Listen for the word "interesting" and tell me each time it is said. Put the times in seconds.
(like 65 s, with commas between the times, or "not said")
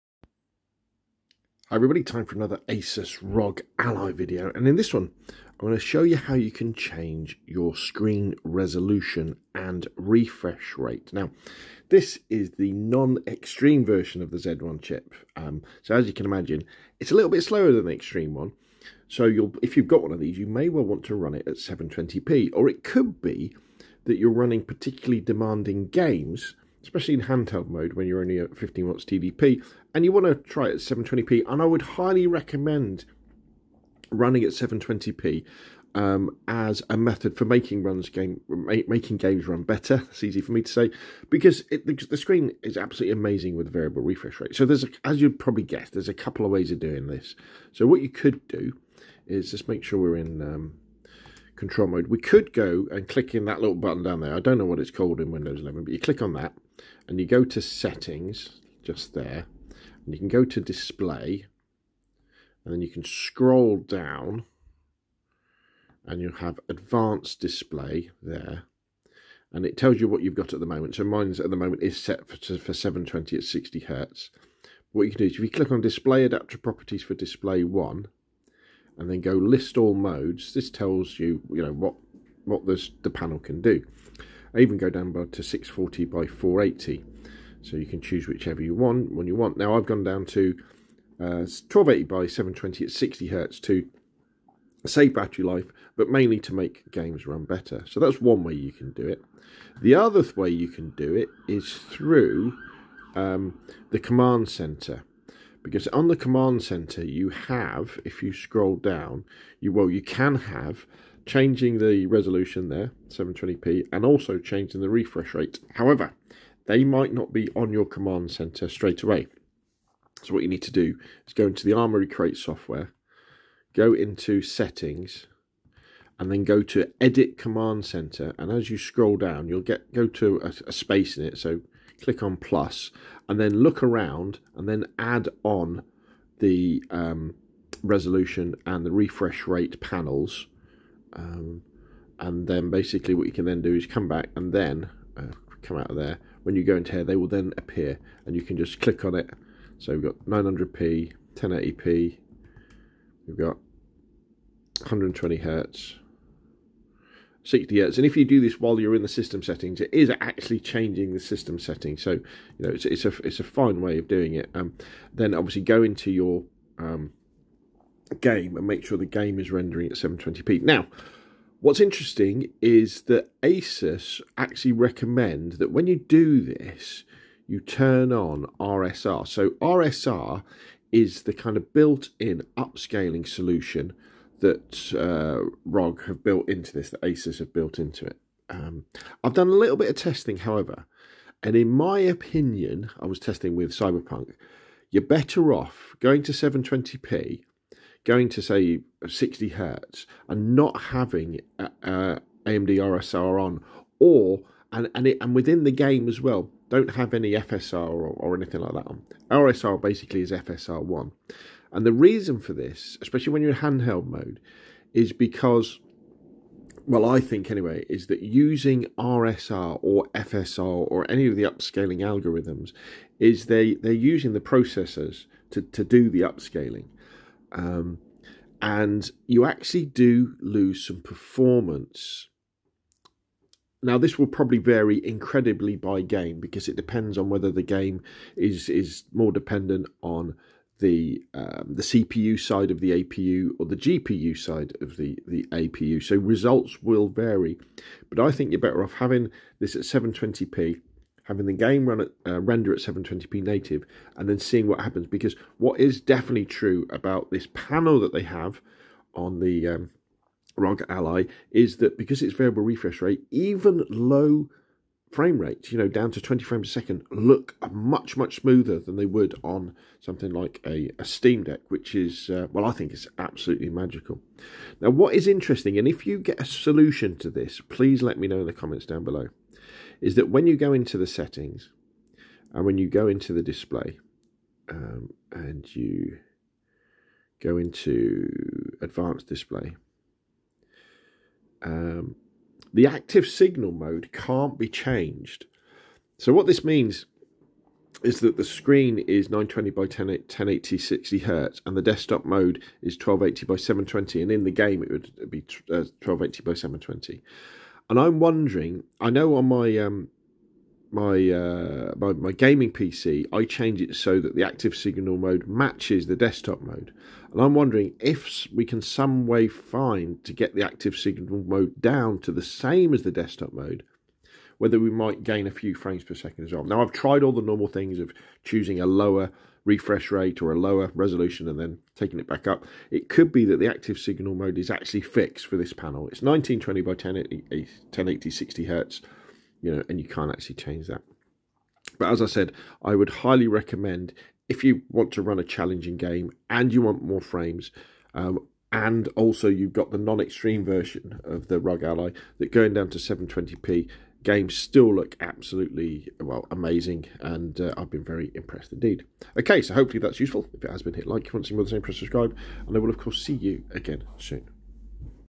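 171 s, 275 s.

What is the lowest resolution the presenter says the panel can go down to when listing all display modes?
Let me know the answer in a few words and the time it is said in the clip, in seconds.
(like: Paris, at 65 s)
640 by 480, at 85 s.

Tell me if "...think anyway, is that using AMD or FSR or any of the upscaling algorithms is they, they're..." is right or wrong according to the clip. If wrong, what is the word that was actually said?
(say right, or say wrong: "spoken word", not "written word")
wrong: "RSR", not "AMD".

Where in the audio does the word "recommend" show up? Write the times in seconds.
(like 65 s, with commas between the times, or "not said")
32 s, 174 s, 343 s.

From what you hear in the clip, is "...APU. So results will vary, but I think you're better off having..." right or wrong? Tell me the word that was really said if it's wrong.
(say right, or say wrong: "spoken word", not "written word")
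right.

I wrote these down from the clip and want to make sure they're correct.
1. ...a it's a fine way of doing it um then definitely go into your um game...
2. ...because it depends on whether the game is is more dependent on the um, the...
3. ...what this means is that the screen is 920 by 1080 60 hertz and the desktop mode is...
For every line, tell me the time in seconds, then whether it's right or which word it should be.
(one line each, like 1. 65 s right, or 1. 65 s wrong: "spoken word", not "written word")
1. 163 s wrong: "obviously", not "definitely"
2. 236 s right
3. 296 s right.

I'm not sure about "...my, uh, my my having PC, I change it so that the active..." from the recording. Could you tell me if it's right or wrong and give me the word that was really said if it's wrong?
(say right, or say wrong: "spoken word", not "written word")
wrong: "gaming", not "having".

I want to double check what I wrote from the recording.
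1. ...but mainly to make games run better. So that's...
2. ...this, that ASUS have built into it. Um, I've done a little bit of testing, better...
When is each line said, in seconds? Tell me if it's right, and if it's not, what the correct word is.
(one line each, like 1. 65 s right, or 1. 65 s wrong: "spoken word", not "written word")
1. 95 s right
2. 186 s wrong: "however", not "better".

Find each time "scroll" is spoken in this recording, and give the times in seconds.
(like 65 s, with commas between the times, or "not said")
63 s, 108 s, 128 s.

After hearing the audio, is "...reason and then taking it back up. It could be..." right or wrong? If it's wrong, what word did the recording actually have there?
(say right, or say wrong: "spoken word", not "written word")
wrong: "resolution", not "reason".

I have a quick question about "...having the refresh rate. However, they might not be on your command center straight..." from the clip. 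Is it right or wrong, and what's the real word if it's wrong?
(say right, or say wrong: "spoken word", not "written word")
wrong: "changing", not "having".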